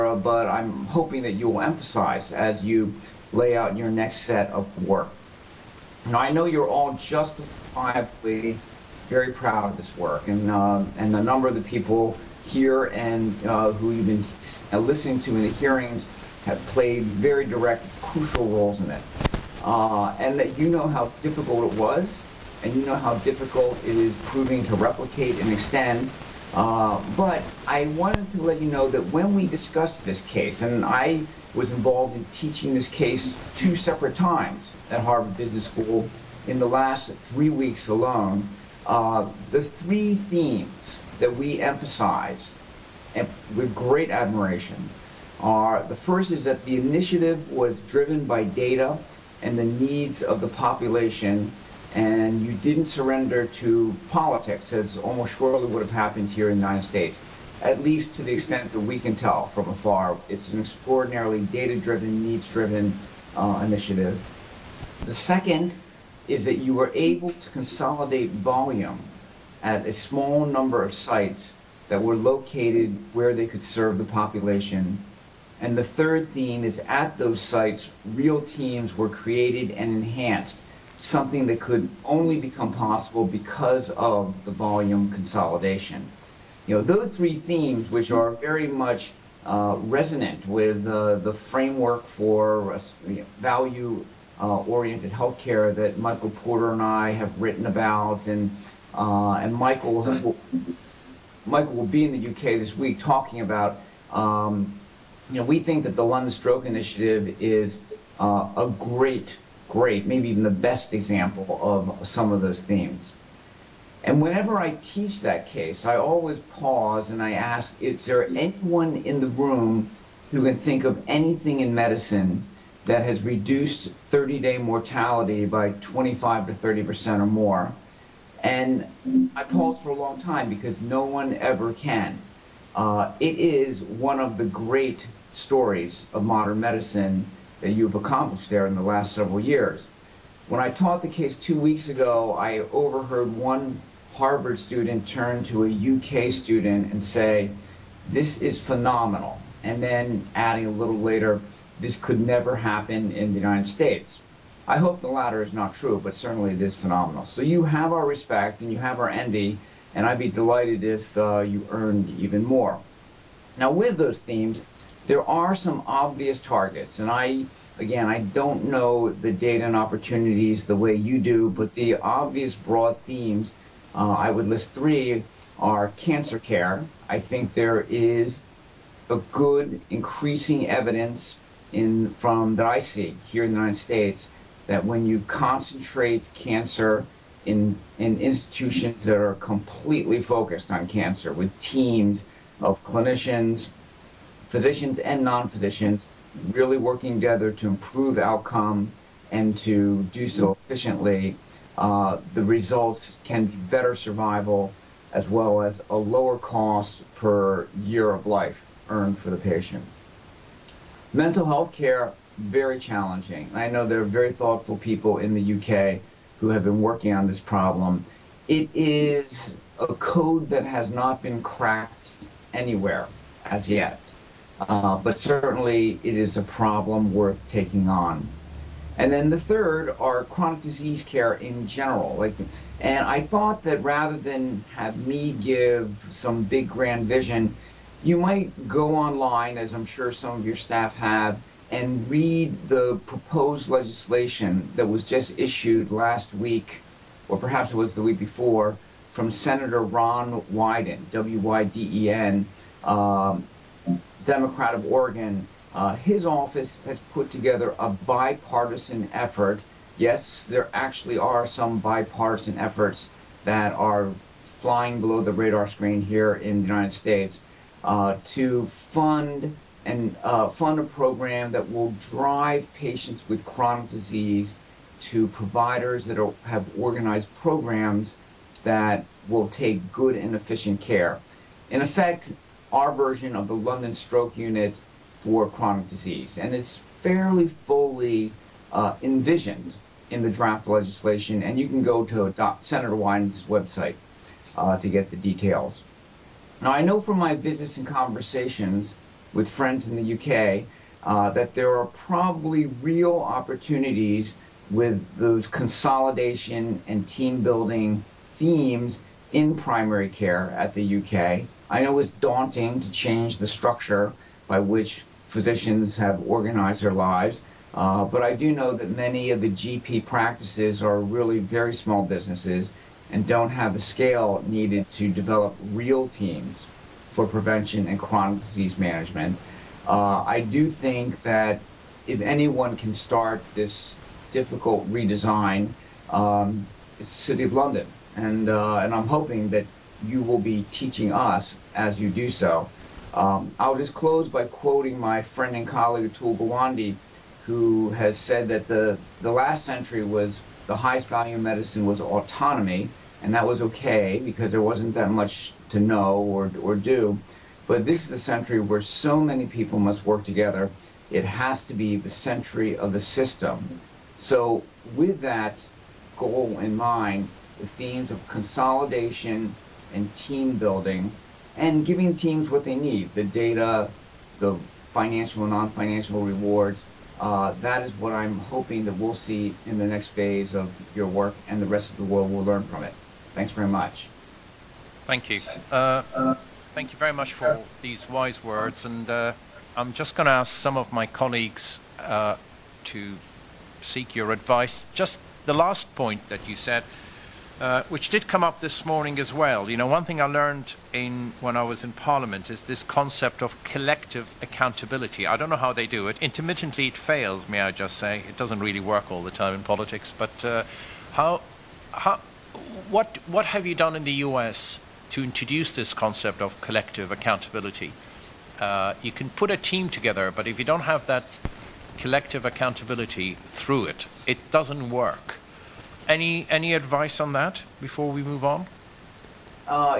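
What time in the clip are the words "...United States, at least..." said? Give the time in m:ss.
0:56.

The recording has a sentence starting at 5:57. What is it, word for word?
But this is a century where so many people must work together.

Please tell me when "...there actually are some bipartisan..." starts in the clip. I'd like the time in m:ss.
4:20.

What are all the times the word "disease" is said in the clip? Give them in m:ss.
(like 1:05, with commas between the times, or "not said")
3:50, 4:33, 4:45, 5:28.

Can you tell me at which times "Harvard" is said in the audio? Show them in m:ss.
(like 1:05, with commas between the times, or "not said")
0:34, 2:24.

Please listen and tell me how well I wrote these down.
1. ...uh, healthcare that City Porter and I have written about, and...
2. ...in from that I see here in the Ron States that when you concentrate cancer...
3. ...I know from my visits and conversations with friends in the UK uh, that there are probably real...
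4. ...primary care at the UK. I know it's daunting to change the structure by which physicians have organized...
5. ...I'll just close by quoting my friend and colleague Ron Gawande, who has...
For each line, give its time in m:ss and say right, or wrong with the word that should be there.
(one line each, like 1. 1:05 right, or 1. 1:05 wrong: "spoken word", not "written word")
1. 1:35 wrong: "Michael", not "City"
2. 3:01 wrong: "United", not "Ron"
3. 4:56 right
4. 5:09 right
5. 5:43 wrong: "Atul", not "Ron".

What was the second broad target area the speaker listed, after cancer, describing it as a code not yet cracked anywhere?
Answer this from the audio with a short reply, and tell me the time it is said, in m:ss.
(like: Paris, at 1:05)
Mental health care, at 3:31.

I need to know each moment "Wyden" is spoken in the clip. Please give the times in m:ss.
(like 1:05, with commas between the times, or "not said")
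4:10, 4:52.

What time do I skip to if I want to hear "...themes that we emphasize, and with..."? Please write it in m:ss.
0:40.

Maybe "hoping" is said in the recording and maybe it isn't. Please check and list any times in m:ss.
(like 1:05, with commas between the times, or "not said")
0:00, 5:39, 6:18.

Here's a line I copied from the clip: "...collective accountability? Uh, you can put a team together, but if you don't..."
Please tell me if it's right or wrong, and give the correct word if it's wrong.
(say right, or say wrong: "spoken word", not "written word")
right.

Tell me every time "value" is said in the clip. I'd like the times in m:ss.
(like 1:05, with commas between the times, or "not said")
1:33, 5:51.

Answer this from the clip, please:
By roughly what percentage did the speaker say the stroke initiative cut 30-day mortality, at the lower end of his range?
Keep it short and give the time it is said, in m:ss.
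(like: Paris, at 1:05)
25%, at 2:05.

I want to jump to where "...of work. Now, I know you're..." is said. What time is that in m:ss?
0:04.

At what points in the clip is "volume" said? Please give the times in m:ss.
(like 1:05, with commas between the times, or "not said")
1:08, 1:24.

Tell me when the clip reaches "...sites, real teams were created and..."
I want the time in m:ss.
1:17.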